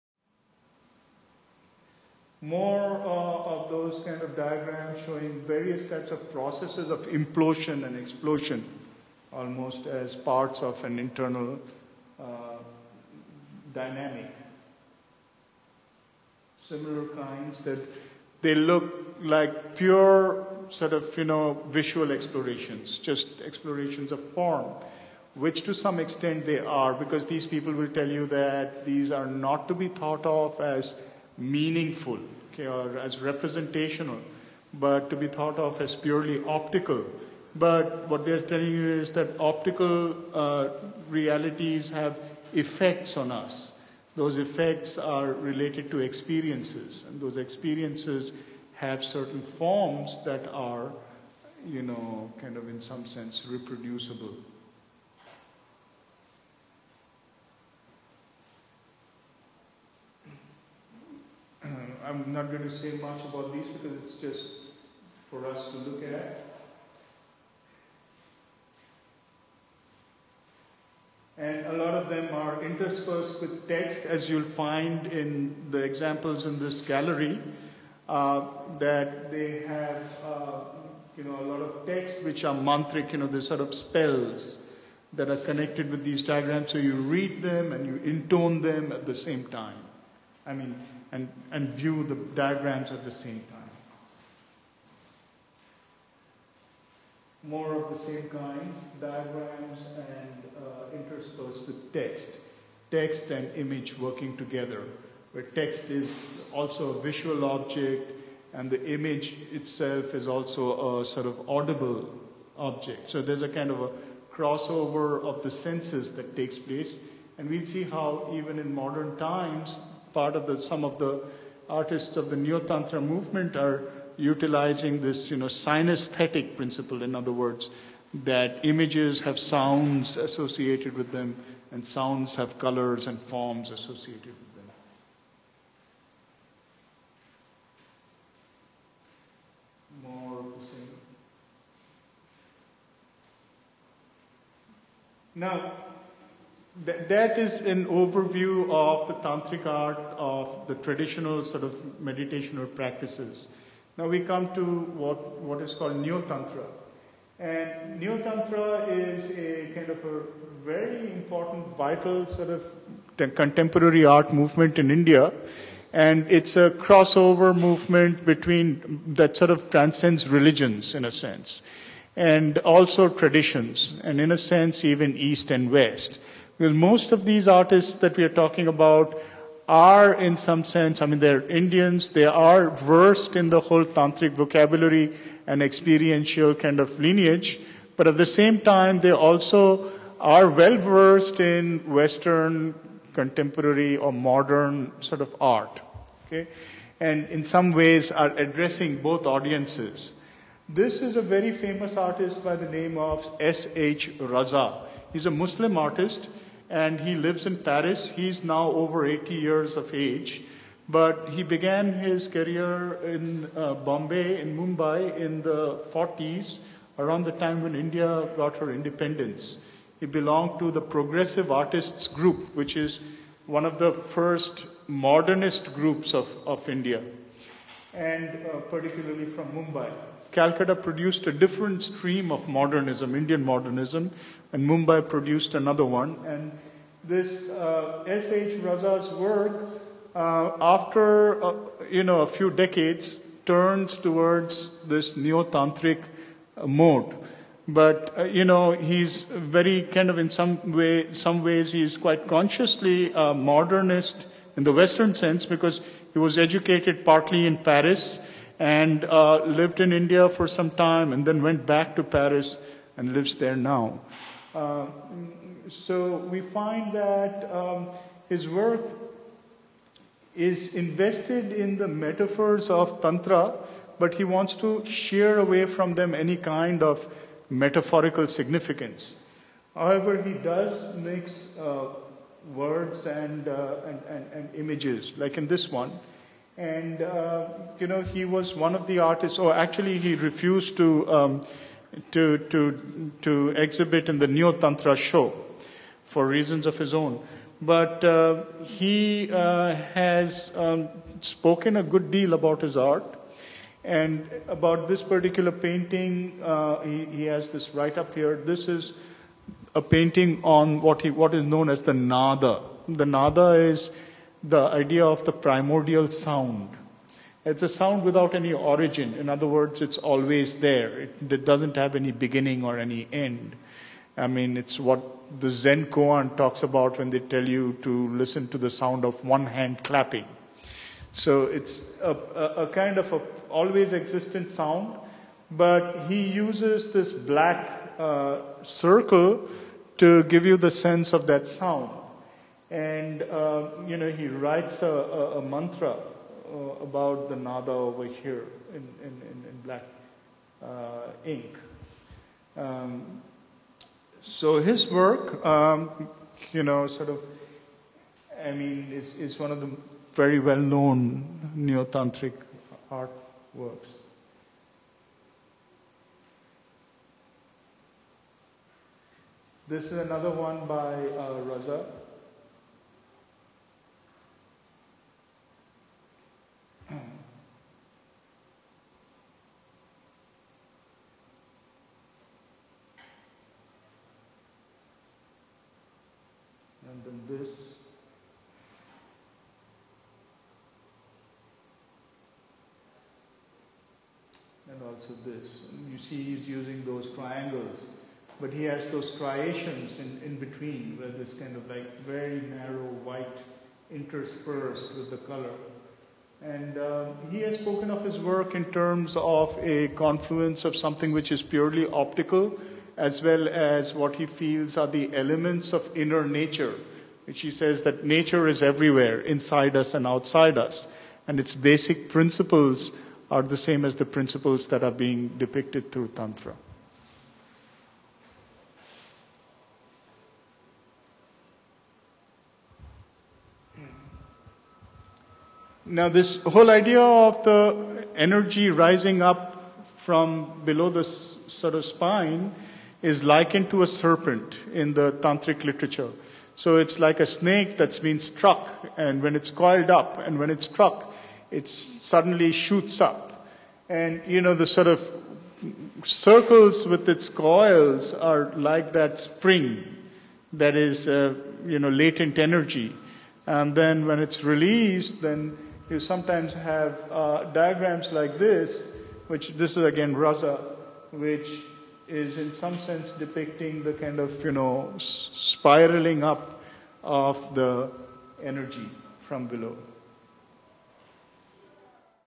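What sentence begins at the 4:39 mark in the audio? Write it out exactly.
However, he does mix uh, words and, uh, and, and, and images, like in this one.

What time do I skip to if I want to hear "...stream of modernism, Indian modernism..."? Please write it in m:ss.
3:51.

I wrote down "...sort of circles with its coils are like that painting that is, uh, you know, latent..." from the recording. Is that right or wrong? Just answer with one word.
wrong.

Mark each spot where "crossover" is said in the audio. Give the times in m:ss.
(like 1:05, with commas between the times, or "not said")
1:54, 2:46.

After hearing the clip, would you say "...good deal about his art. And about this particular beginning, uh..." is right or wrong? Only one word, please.
wrong.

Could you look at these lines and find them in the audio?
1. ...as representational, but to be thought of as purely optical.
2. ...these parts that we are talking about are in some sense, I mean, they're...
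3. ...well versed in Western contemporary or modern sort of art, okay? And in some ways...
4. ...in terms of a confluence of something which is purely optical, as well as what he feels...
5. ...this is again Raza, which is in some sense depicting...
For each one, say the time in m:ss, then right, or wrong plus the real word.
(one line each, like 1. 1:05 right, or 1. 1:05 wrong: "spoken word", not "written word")
1. 0:32 right
2. 2:57 wrong: "artists", not "parts"
3. 3:10 right
4. 6:48 right
5. 7:49 right.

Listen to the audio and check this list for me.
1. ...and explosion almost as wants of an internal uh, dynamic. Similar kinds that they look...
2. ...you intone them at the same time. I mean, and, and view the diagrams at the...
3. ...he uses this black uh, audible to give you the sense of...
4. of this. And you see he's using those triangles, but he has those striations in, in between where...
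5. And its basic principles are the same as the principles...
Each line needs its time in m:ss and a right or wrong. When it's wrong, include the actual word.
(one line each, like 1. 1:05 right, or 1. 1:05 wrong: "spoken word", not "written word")
1. 0:07 wrong: "parts", not "wants"
2. 1:27 right
3. 5:36 wrong: "circle", not "audible"
4. 6:35 right
5. 7:01 right.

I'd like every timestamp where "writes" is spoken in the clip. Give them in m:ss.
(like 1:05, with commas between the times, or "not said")
5:44.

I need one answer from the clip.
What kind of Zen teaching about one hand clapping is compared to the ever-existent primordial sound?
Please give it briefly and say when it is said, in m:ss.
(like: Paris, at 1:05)
Zen koan, at 5:25.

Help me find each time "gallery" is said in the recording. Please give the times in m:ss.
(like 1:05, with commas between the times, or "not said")
1:16.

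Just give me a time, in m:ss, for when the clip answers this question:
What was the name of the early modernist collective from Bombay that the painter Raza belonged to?
3:40.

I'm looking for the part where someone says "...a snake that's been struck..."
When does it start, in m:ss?
7:27.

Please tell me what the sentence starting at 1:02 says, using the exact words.
I'm not going to say much about these because it's just for us to look at.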